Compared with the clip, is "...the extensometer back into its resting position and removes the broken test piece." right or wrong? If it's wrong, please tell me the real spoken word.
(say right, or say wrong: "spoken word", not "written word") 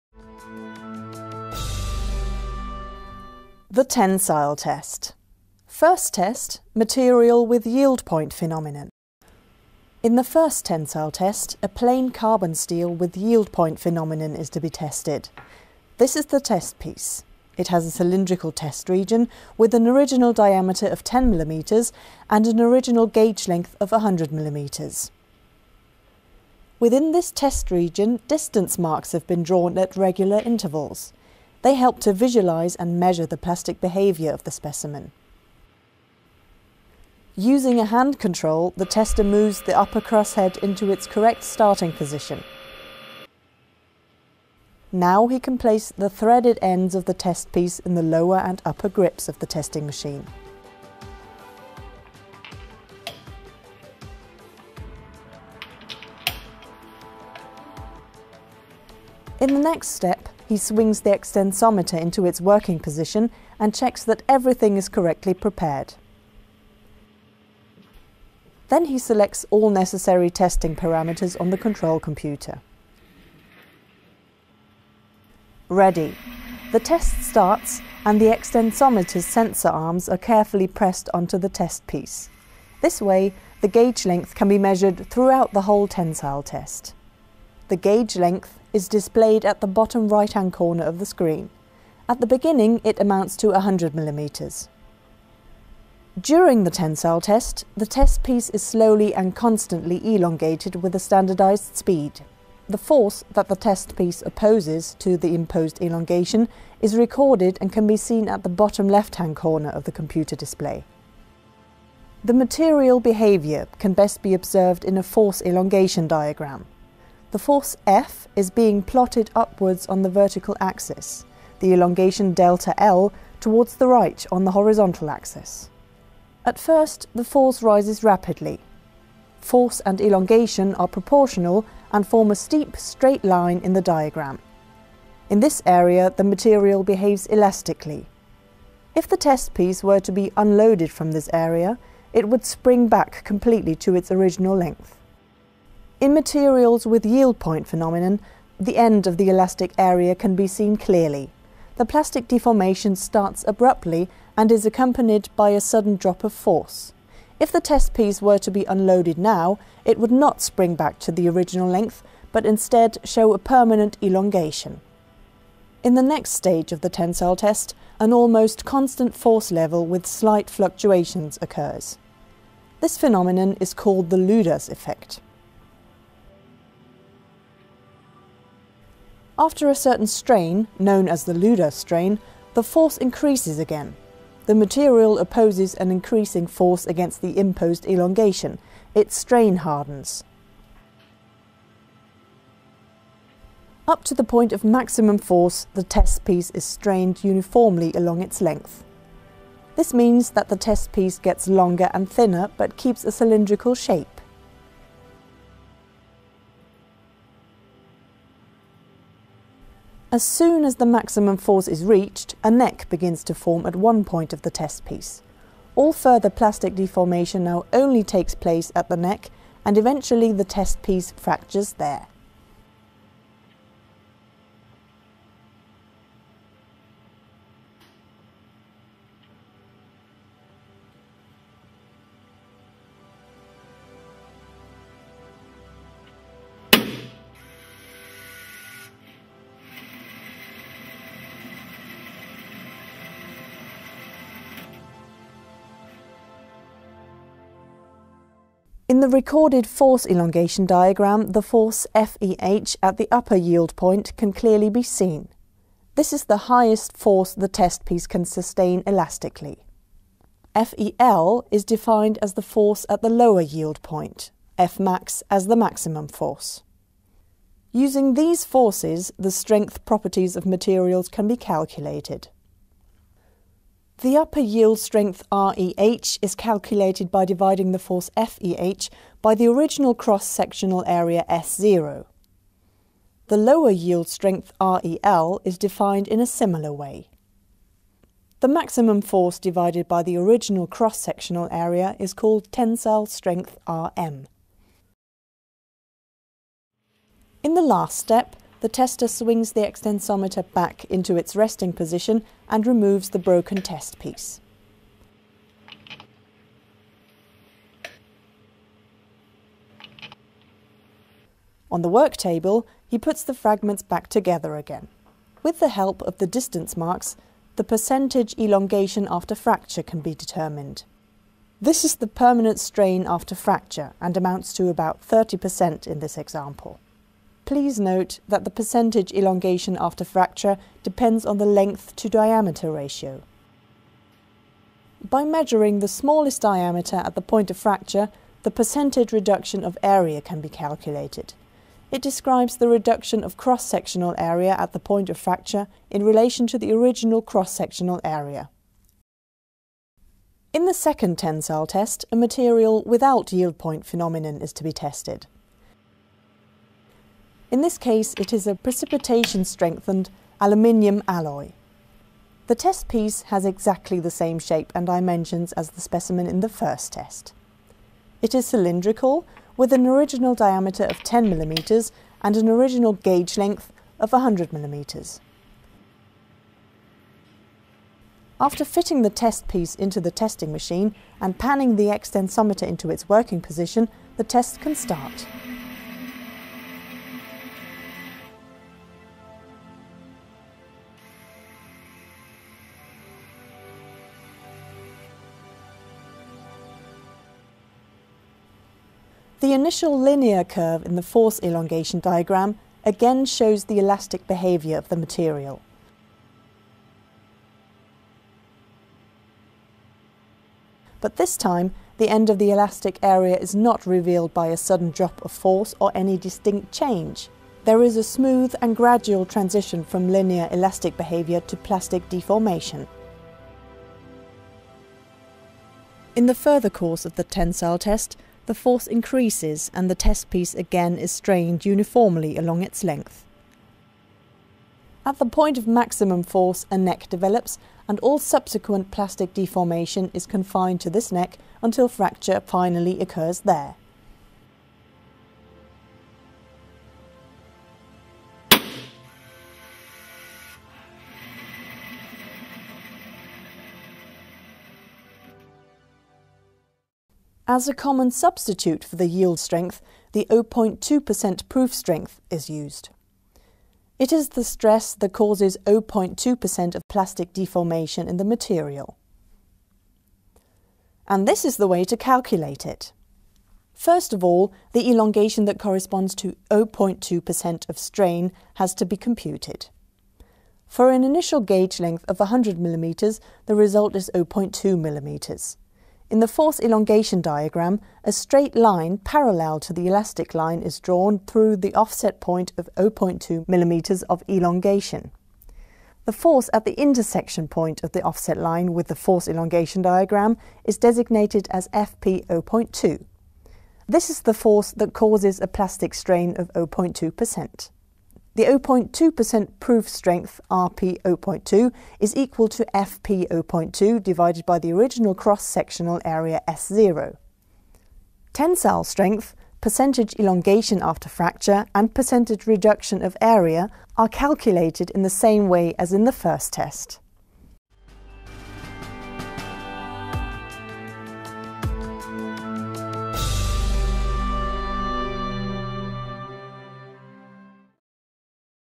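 right.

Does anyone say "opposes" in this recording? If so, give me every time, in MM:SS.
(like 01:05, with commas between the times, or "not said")
01:44, 03:05.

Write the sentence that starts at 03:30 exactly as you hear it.
As soon as the maximum force is reached, a neck begins to form at one point of the test piece.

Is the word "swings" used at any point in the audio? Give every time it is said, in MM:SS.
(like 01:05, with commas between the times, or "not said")
01:00, 04:59.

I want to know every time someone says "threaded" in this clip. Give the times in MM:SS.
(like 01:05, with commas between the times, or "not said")
00:46.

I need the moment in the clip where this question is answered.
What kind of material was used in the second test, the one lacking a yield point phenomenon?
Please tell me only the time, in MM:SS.
05:58.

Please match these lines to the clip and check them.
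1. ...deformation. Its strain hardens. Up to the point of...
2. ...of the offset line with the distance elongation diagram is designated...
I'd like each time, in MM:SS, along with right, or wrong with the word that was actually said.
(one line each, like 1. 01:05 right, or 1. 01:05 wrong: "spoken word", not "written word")
1. 03:07 wrong: "elongation", not "deformation"
2. 08:17 wrong: "force", not "distance".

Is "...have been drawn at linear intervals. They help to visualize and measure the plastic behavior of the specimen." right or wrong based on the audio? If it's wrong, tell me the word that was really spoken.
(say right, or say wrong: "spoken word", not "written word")
wrong: "regular", not "linear".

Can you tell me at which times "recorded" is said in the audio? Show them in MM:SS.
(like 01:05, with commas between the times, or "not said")
01:46, 04:09.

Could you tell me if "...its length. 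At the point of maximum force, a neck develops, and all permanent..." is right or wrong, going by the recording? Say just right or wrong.
wrong.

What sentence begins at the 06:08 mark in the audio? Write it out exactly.
It is cylindrical, with an original diameter of 10 mm and an original gauge length of 100 mm.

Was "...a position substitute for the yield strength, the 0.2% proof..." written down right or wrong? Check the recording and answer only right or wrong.
wrong.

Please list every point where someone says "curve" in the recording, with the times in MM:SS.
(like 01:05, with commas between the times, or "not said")
06:40.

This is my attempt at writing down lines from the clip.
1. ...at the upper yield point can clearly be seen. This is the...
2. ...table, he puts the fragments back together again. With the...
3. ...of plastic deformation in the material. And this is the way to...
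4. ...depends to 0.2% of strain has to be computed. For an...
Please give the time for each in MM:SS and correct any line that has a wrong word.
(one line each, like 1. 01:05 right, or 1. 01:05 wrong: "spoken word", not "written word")
1. 04:12 right
2. 05:12 right
3. 07:46 right
4. 07:55 wrong: "corresponds", not "depends".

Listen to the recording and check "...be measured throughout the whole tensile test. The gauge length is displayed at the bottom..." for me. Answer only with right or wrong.
right.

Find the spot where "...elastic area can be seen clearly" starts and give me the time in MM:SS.
02:29.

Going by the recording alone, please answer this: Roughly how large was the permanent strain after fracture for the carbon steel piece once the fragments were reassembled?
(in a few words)
30%.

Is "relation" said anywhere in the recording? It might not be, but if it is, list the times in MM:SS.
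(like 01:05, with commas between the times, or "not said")
05:46.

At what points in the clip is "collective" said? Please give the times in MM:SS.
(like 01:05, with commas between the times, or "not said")
not said.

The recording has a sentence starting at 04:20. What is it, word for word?
FEL is defined as the force at the lower yield point, Fmax as the maximum force.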